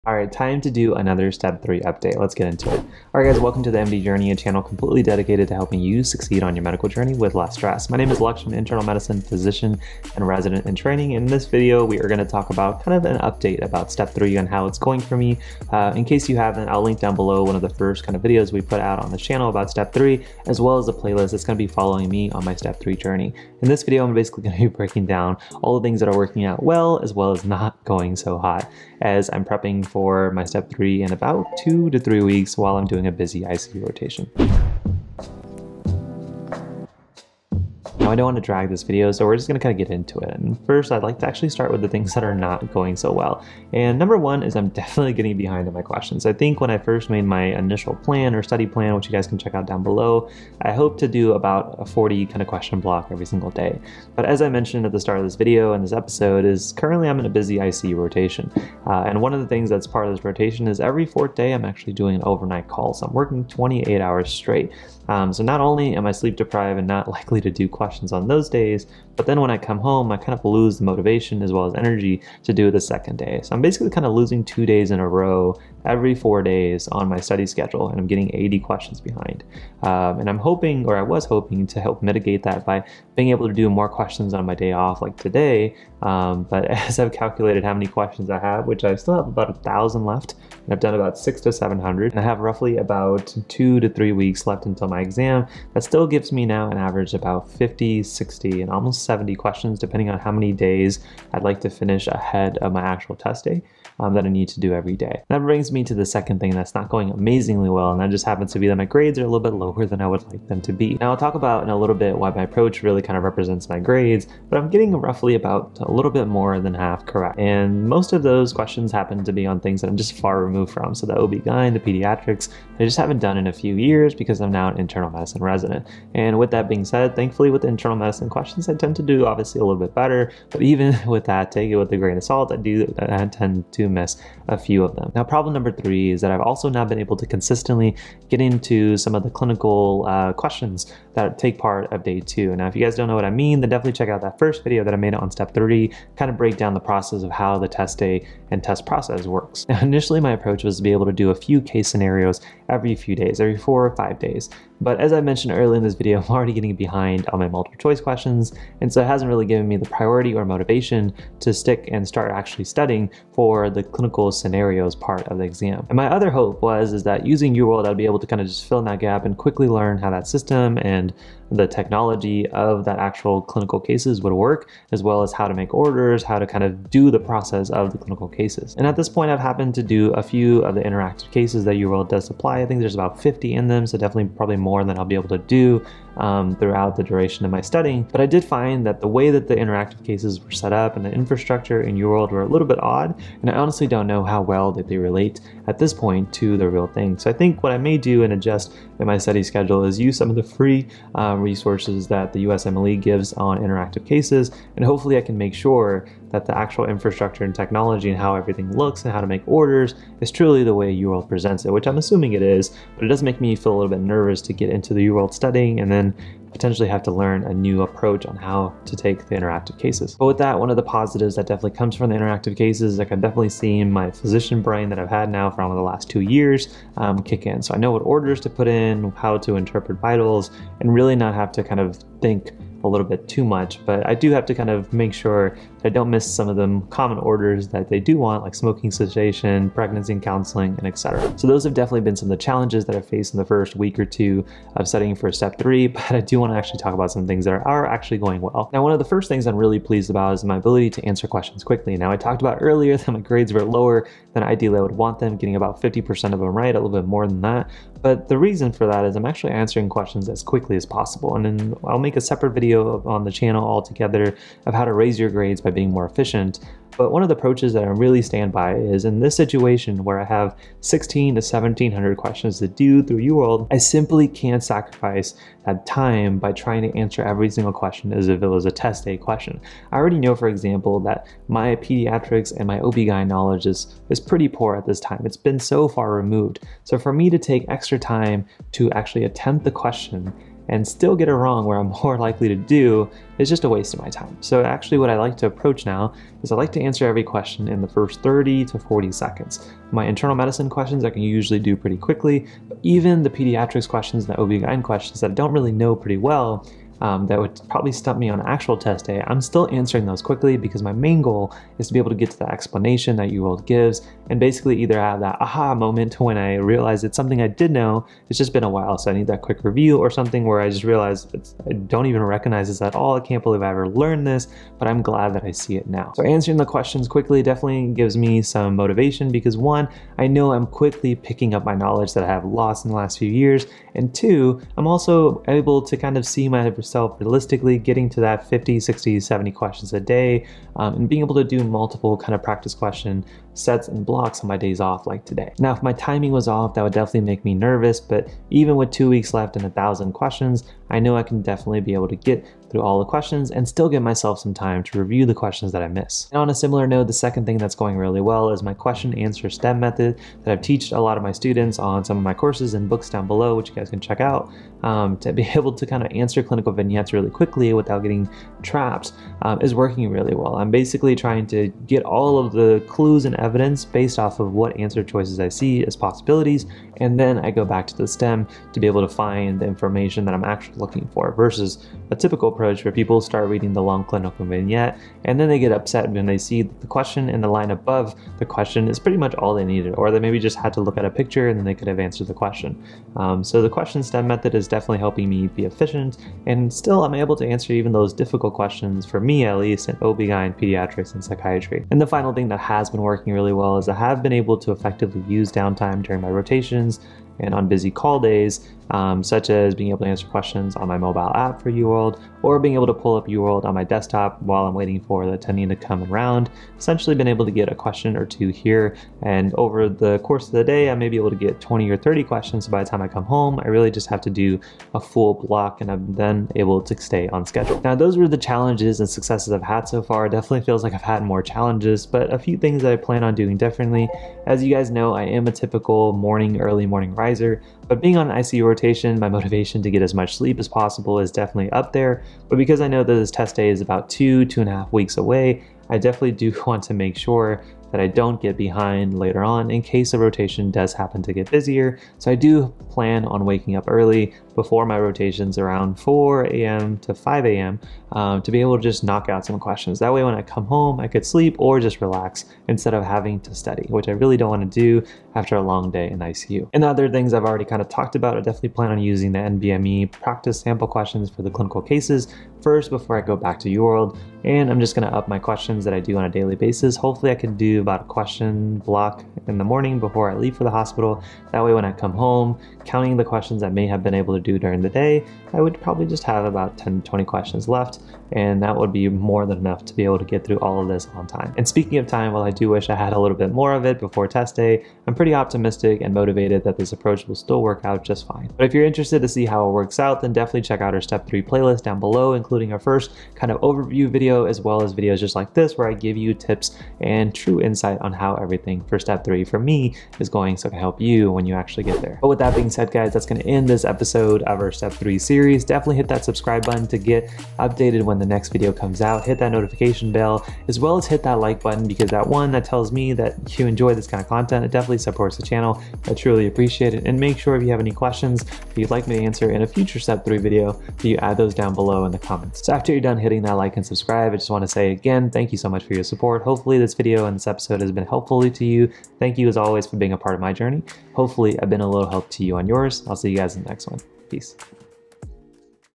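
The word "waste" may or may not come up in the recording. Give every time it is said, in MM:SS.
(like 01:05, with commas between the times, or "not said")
04:53.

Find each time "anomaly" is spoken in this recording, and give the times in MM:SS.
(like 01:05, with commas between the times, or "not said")
not said.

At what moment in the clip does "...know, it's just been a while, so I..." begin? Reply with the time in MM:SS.
05:17.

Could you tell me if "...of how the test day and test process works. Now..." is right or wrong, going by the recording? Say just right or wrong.
right.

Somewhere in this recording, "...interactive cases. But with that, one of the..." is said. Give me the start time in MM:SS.
03:39.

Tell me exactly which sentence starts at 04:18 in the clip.
But the reason for that is I'm actually answering questions as quickly as possible.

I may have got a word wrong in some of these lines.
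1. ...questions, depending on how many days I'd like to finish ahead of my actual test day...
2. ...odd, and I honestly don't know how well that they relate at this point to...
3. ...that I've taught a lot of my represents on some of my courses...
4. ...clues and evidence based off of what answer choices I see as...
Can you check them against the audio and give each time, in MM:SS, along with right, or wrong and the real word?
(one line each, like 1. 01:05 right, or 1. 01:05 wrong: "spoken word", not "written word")
1. 01:39 right
2. 03:12 right
3. 06:00 wrong: "students", not "represents"
4. 06:12 right.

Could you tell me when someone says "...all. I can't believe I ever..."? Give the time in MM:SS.
05:22.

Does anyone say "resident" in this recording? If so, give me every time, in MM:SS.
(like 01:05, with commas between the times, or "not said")
00:10, 02:05.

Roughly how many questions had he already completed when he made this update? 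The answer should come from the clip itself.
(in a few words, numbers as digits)
600 to 700.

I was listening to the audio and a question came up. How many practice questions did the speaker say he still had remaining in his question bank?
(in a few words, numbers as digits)
about a thousand.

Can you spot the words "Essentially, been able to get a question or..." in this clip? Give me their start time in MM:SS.
06:56.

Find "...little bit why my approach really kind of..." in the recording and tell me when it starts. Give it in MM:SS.
01:51.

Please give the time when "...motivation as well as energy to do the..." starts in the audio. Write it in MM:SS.
01:10.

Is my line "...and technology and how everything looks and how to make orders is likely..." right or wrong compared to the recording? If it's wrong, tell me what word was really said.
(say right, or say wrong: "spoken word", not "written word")
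wrong: "truly", not "likely".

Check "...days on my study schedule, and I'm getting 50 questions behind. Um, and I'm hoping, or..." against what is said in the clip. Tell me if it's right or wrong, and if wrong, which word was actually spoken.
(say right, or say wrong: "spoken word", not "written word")
wrong: "80", not "50".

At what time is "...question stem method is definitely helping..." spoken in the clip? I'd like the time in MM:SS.
06:33.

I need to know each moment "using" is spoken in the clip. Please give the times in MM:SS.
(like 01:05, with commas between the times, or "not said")
02:47, 07:48.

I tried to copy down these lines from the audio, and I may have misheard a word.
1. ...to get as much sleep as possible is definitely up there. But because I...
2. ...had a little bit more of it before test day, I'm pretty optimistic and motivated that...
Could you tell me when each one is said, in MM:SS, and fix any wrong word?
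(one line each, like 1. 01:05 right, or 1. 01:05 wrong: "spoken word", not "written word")
1. 07:19 right
2. 08:12 right.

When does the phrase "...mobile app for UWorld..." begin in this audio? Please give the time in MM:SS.
06:50.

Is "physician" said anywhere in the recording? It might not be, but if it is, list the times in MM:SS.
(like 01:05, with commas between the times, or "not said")
00:09, 03:44.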